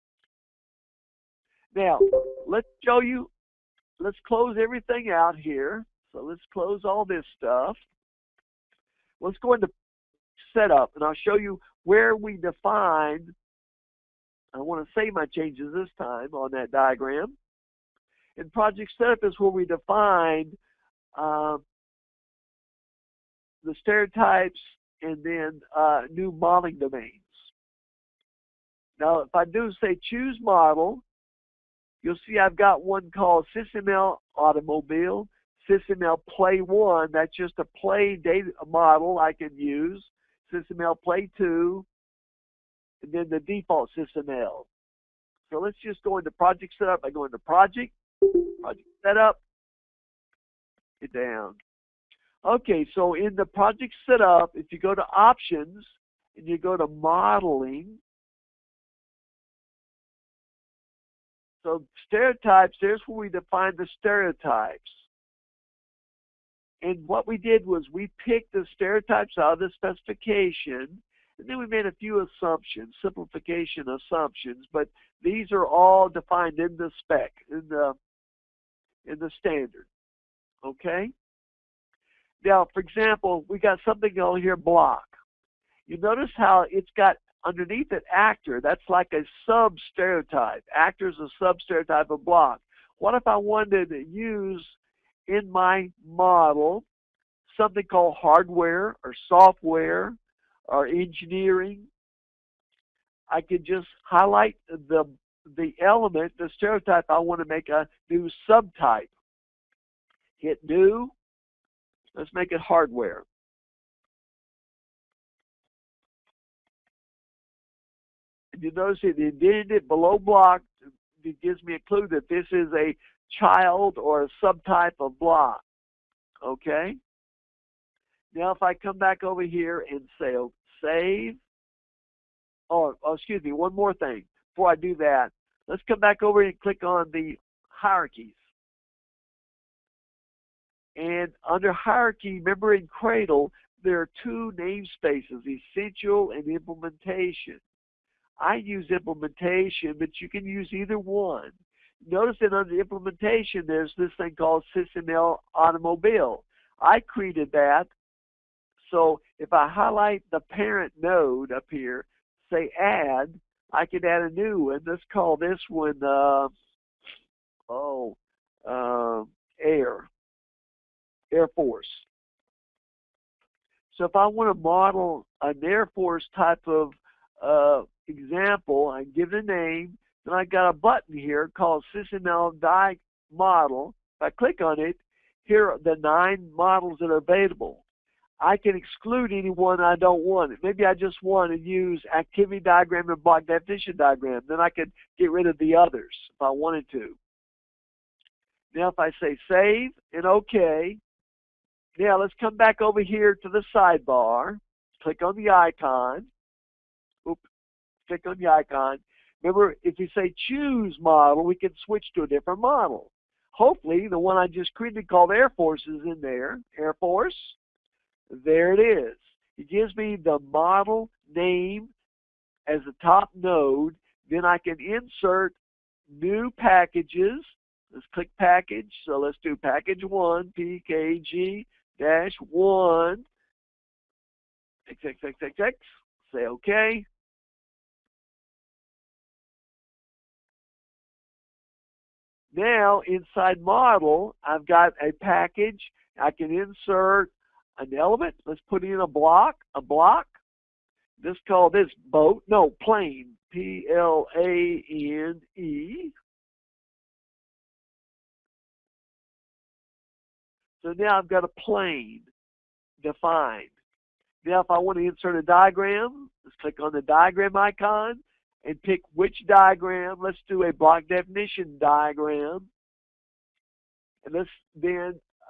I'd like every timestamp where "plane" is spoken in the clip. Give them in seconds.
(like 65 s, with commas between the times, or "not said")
252 s, 261 s.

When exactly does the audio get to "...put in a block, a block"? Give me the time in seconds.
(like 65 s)
248 s.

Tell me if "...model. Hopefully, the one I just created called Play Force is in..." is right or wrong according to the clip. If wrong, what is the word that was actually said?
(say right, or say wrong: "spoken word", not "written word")
wrong: "Air", not "Play".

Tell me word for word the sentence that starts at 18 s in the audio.
And project setup is where we define uh, um, the stereotypes and then uh, new modeling domains.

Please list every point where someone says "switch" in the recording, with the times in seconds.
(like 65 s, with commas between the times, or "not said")
211 s.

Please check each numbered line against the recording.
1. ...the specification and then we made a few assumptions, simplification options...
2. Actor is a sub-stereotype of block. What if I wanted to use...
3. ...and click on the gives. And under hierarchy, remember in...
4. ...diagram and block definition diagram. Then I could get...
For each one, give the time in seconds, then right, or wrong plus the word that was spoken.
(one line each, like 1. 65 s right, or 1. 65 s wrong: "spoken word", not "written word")
1. 69 s wrong: "assumptions", not "options"
2. 90 s right
3. 136 s wrong: "hierarchies", not "gives"
4. 192 s right.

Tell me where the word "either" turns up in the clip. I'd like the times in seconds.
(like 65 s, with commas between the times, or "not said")
150 s.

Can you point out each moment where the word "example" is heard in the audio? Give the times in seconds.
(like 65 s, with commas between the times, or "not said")
82 s, 178 s.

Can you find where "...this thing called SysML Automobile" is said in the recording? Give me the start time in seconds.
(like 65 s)
153 s.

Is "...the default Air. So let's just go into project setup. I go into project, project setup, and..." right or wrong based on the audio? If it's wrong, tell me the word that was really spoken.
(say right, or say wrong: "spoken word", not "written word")
wrong: "SysML", not "Air".